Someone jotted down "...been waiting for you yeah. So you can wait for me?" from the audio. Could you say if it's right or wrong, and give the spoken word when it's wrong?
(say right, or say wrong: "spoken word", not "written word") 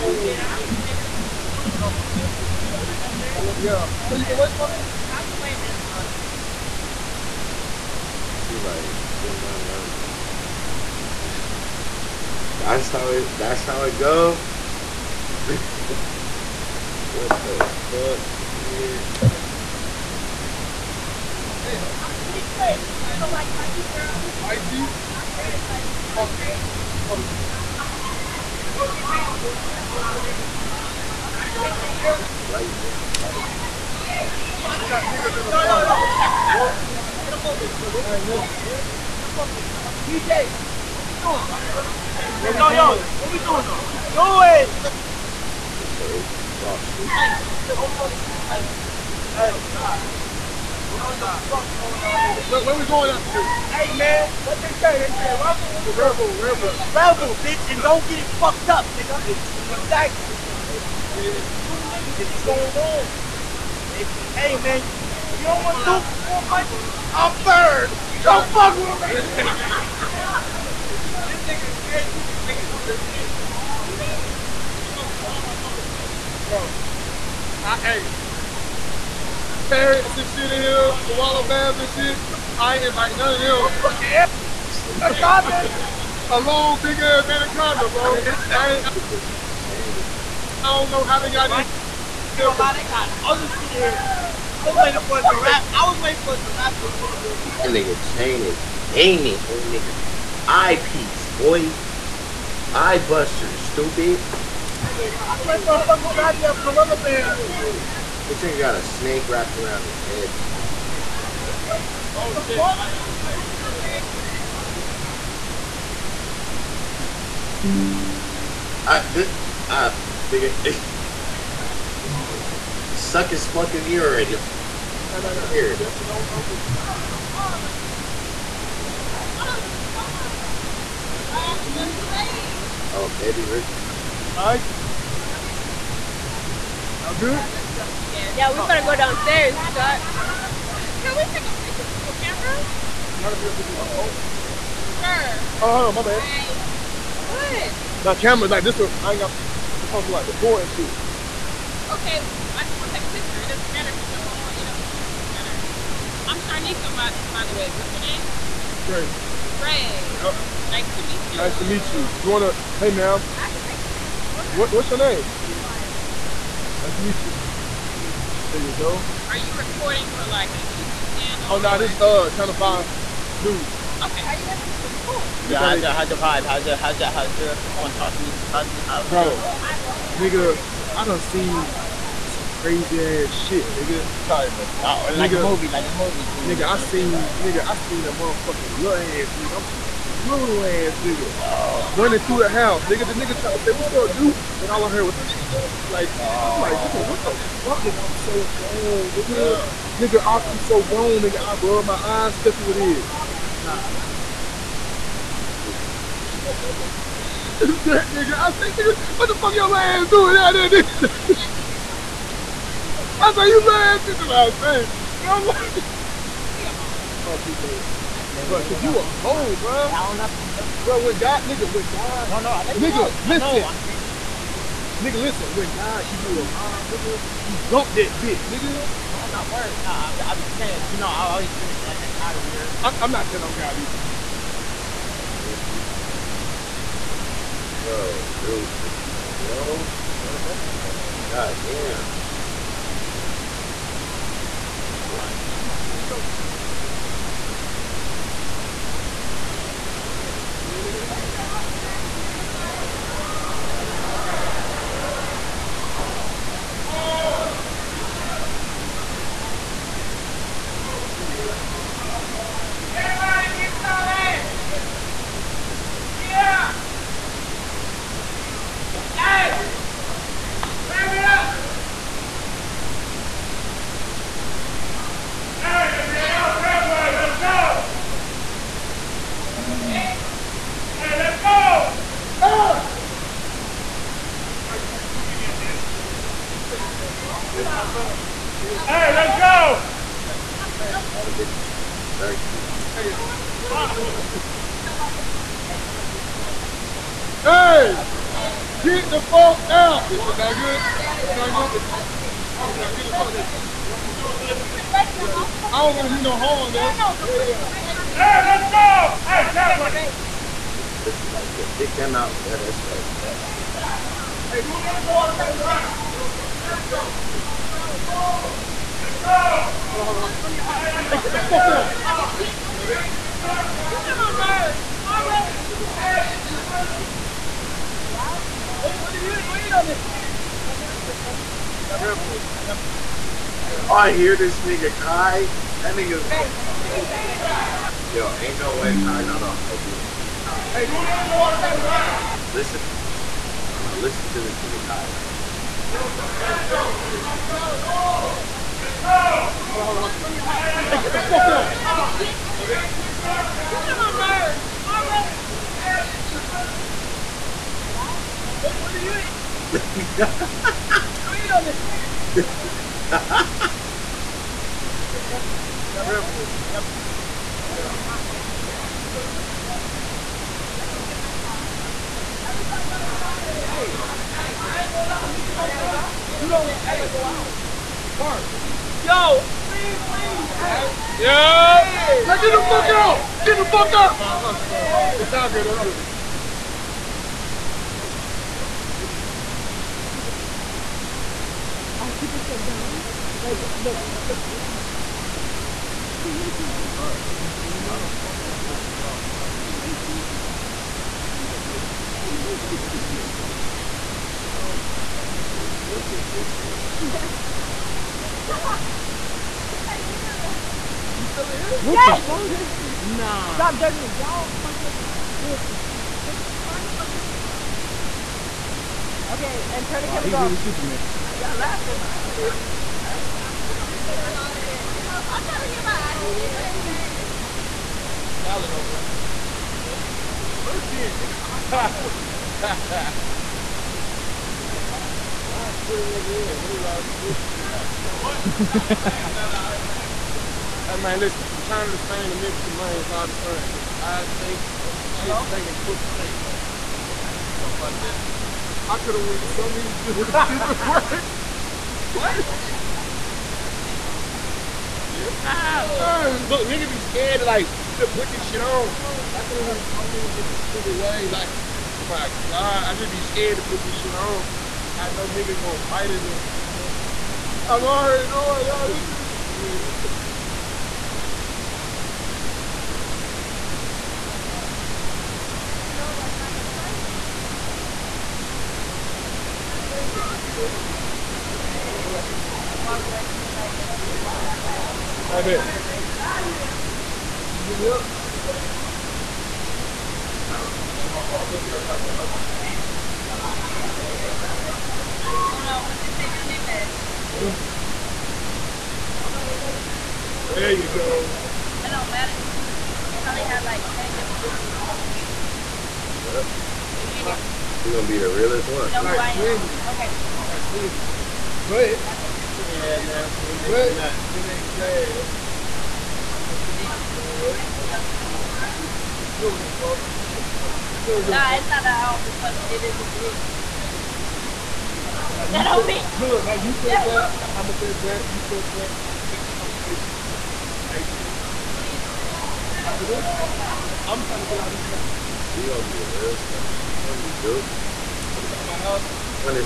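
right.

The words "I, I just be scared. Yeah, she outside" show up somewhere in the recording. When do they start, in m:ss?
7:48.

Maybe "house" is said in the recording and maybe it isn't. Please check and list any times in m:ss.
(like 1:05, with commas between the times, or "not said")
3:12, 8:58.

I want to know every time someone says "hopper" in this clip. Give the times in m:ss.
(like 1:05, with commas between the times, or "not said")
not said.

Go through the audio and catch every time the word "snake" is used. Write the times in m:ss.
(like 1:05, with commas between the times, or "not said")
1:48, 1:53.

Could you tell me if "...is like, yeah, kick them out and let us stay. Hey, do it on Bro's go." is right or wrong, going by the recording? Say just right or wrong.
wrong.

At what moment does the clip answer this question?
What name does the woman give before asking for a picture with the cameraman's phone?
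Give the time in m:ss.
2:36.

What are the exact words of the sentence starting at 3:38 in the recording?
Yeah, bro, cause you a hoe, bro.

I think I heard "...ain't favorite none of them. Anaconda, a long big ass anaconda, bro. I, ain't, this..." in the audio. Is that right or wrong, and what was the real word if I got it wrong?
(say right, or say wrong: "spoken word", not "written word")
wrong: "invite", not "favorite".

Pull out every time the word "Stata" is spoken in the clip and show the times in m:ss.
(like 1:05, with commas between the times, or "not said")
not said.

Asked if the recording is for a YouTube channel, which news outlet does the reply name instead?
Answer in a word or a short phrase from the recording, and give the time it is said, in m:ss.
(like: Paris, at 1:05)
Channel Five News, at 2:52.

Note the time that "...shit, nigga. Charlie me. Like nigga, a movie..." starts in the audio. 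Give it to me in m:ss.
3:03.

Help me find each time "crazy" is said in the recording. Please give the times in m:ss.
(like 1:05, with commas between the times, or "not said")
0:27, 3:02.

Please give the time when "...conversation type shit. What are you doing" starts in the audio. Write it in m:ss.
8:49.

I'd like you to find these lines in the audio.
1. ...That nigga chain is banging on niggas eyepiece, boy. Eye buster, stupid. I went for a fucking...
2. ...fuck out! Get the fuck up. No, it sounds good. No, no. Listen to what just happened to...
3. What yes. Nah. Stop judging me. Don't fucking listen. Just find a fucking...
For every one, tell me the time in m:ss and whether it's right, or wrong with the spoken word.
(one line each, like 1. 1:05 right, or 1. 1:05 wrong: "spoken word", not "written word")
1. 1:37 right
2. 6:22 right
3. 6:51 right.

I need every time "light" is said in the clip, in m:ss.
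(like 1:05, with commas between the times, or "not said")
8:04.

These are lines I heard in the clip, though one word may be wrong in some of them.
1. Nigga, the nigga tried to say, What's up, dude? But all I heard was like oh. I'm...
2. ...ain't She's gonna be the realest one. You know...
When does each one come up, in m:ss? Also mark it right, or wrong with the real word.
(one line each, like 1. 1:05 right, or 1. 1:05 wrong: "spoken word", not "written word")
1. 3:12 right
2. 8:27 right.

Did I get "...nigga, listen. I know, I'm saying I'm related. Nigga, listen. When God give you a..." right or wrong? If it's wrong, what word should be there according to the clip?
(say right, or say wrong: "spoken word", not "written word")
right.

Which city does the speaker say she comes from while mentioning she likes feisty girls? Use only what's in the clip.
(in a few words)
Detroit.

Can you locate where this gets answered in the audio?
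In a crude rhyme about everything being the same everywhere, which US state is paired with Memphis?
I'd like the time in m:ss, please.
7:22.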